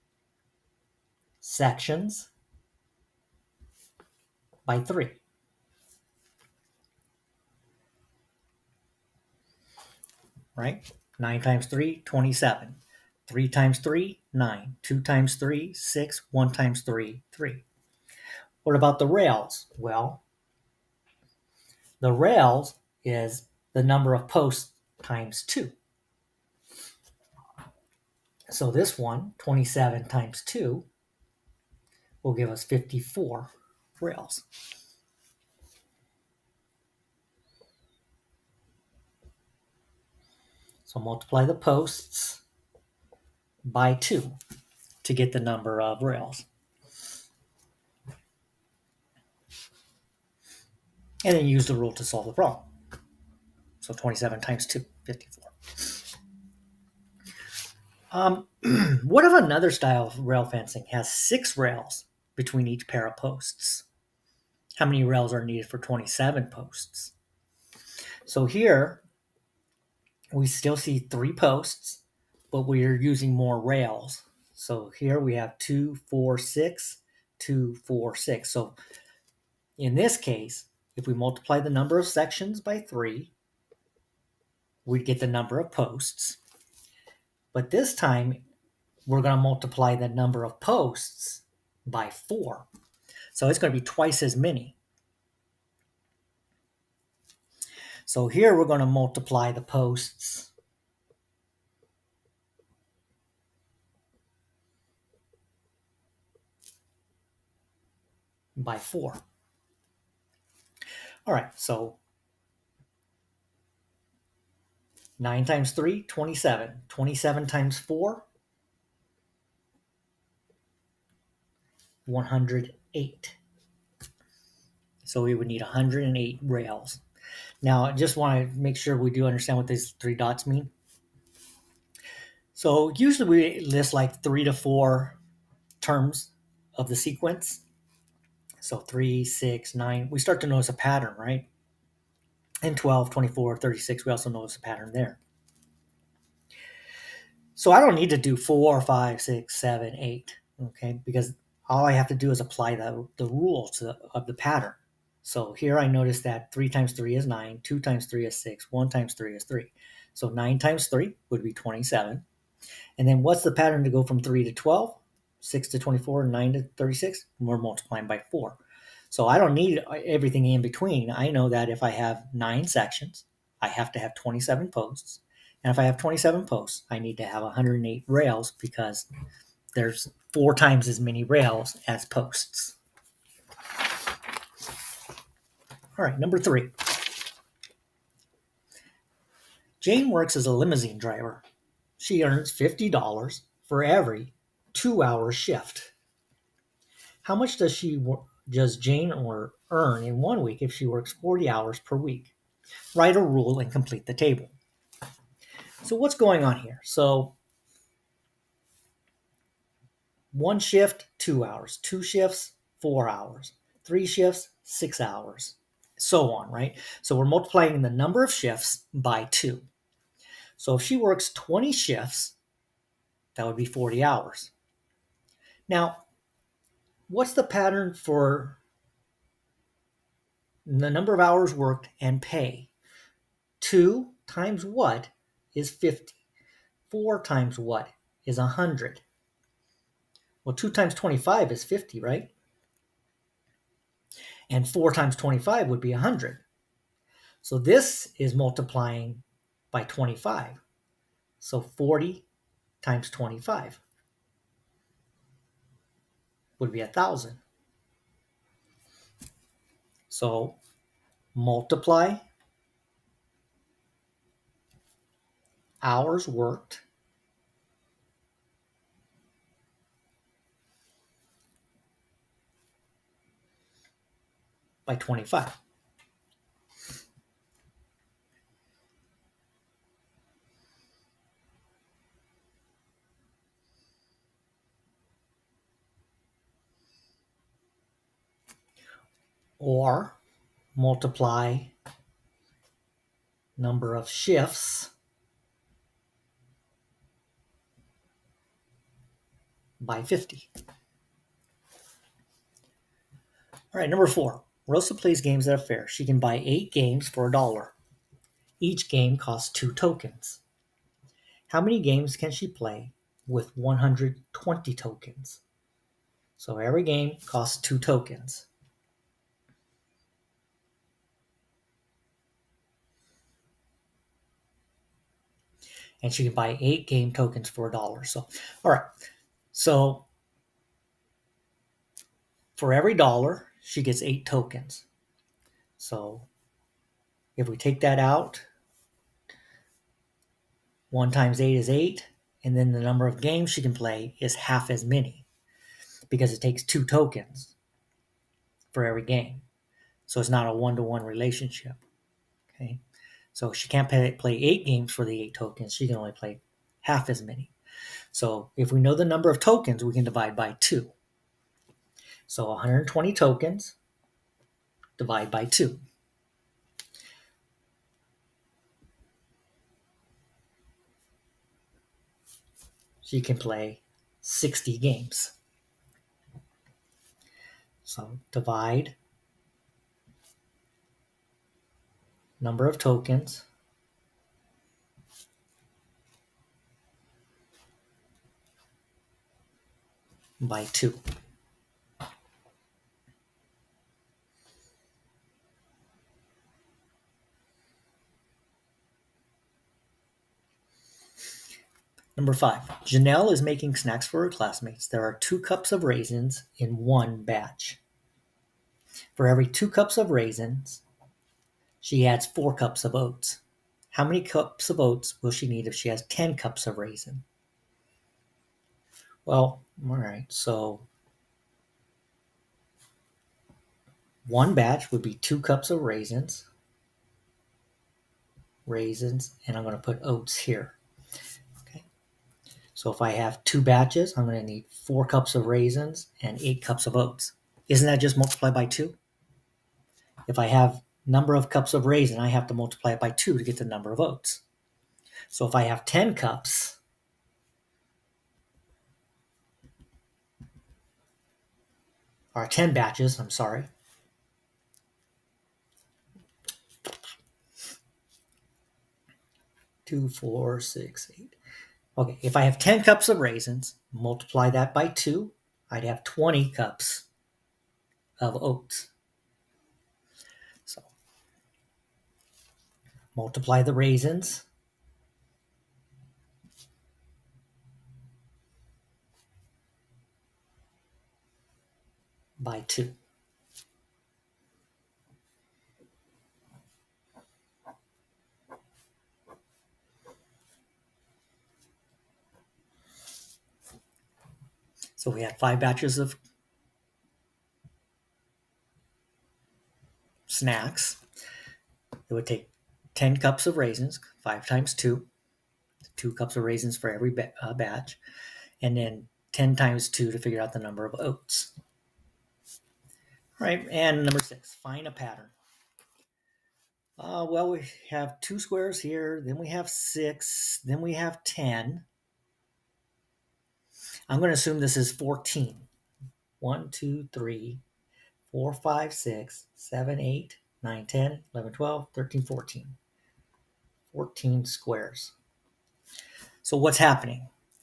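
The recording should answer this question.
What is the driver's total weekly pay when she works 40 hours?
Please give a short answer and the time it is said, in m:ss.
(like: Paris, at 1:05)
1,000, at 4:16.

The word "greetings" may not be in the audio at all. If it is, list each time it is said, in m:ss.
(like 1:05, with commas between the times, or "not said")
not said.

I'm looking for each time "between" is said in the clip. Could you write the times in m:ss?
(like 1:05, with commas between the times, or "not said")
1:02, 2:50.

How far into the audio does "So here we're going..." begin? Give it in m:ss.
1:38.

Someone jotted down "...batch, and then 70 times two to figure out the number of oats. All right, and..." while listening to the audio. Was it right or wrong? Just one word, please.
wrong.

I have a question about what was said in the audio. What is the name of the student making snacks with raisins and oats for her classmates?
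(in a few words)
Janelle.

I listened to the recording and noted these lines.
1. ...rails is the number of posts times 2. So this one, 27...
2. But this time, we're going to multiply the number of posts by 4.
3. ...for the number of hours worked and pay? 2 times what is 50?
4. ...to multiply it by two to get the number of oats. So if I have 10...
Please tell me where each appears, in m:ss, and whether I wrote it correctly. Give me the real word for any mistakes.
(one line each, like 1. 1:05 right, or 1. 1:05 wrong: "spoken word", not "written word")
1. 0:22 right
2. 1:27 right
3. 3:47 right
4. 7:22 right.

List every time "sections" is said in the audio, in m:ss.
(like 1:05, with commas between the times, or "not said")
0:01, 1:22, 2:52.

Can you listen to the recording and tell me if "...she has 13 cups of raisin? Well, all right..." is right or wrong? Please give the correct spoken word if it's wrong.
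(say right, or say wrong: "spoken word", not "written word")
wrong: "10", not "13".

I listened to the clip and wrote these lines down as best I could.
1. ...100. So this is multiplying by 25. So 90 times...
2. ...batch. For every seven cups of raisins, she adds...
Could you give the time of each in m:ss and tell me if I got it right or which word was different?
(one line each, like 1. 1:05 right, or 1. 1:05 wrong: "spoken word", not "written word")
1. 4:05 wrong: "40", not "90"
2. 6:47 wrong: "two", not "seven".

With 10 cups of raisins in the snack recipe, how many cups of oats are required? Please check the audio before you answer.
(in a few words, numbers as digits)
20.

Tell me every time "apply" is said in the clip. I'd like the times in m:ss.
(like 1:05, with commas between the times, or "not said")
2:32.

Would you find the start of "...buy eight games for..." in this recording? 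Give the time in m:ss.
5:06.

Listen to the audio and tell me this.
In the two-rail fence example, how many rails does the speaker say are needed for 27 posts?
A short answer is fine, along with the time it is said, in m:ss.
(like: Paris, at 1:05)
54, at 0:32.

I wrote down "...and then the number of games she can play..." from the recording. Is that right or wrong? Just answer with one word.
right.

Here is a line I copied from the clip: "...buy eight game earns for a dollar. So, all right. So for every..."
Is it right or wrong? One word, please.
wrong.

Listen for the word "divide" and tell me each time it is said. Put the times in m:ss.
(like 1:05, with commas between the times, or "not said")
6:00, 6:04, 6:18.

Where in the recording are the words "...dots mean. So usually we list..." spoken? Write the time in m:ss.
2:10.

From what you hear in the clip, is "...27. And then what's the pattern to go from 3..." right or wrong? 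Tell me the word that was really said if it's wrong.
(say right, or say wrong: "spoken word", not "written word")
right.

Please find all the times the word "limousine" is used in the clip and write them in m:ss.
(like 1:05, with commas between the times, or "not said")
3:10.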